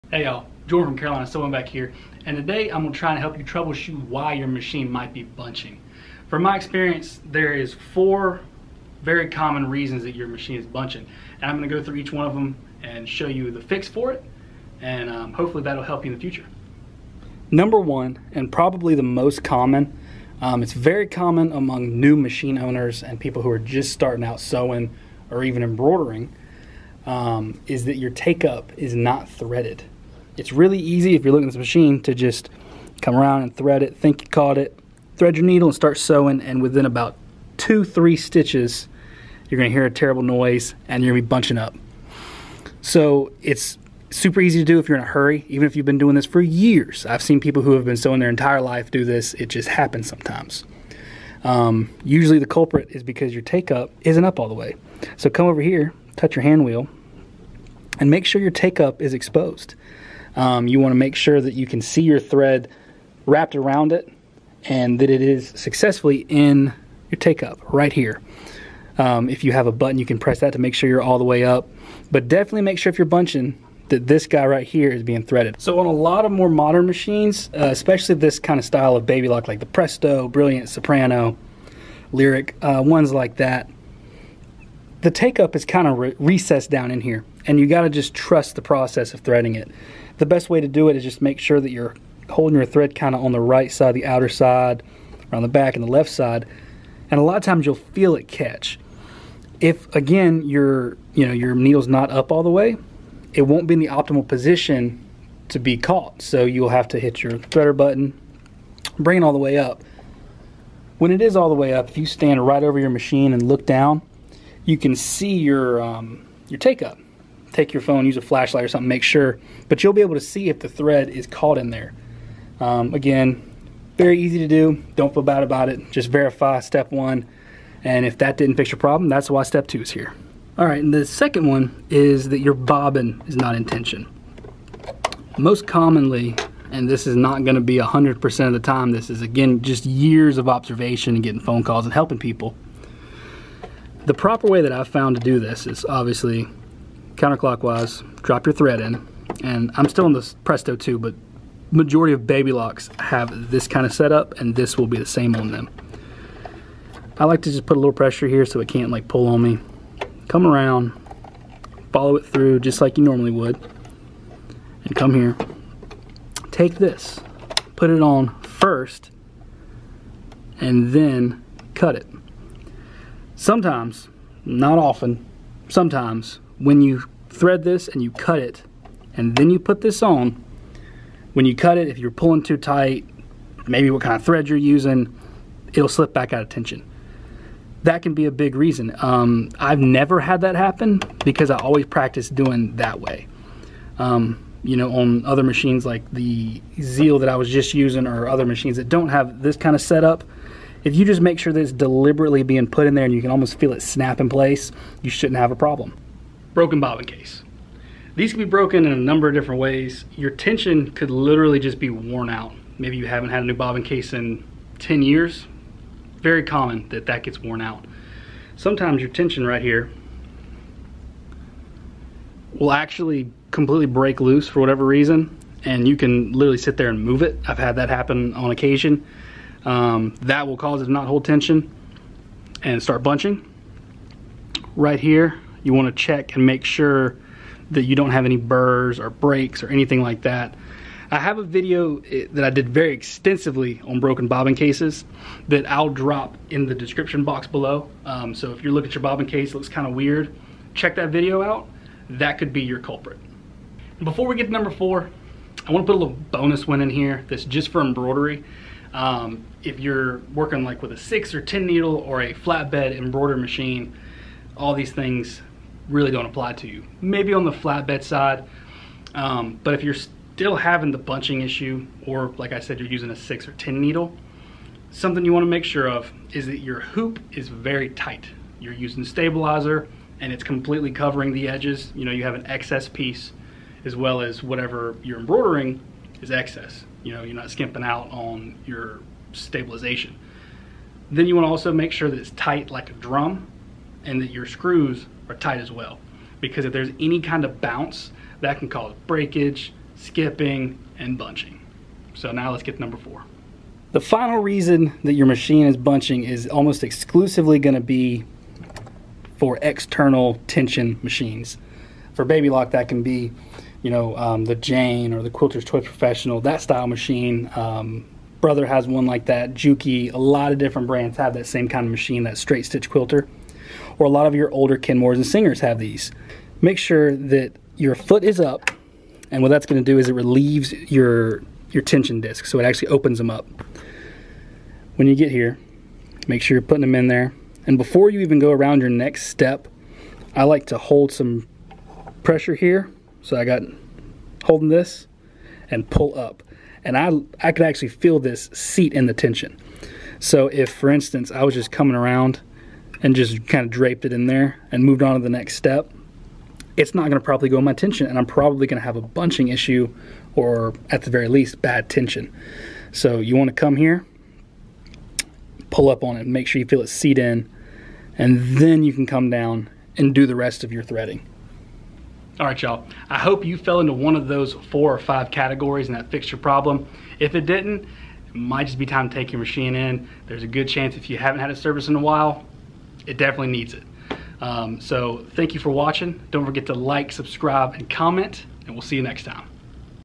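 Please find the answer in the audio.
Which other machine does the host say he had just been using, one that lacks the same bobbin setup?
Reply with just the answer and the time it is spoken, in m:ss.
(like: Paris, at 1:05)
Zeal, at 3:16.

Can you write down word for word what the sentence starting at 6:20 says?
There's a good chance if you haven't had a service in a while, it definitely needs it.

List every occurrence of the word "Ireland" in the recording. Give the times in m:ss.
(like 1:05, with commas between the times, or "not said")
not said.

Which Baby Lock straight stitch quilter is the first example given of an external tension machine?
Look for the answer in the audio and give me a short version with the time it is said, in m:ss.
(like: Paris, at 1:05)
the Jane, at 5:14.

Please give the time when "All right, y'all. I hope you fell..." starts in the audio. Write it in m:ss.
6:12.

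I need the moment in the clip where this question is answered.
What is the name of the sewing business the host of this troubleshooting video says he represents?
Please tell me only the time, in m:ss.
0:00.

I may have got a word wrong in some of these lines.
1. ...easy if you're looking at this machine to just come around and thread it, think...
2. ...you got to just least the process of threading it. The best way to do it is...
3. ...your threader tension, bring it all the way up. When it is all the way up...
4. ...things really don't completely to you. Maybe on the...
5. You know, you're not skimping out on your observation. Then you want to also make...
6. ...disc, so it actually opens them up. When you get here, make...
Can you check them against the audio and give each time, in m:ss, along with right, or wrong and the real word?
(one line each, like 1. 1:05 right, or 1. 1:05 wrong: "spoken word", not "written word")
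1. 0:30 right
2. 1:27 wrong: "trust", not "least"
3. 1:47 wrong: "button", not "tension"
4. 4:24 wrong: "apply", not "completely"
5. 4:47 wrong: "stabilization", not "observation"
6. 5:32 right.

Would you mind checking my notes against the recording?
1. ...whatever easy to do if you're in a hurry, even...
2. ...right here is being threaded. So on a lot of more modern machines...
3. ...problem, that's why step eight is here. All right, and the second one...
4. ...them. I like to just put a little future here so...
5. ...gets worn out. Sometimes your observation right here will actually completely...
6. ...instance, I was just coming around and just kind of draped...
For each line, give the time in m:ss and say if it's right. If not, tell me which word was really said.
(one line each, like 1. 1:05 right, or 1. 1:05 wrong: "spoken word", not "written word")
1. 0:44 wrong: "super", not "whatever"
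2. 1:14 right
3. 2:08 wrong: "two", not "eight"
4. 2:35 wrong: "pressure", not "future"
5. 3:37 wrong: "tension", not "observation"
6. 5:50 right.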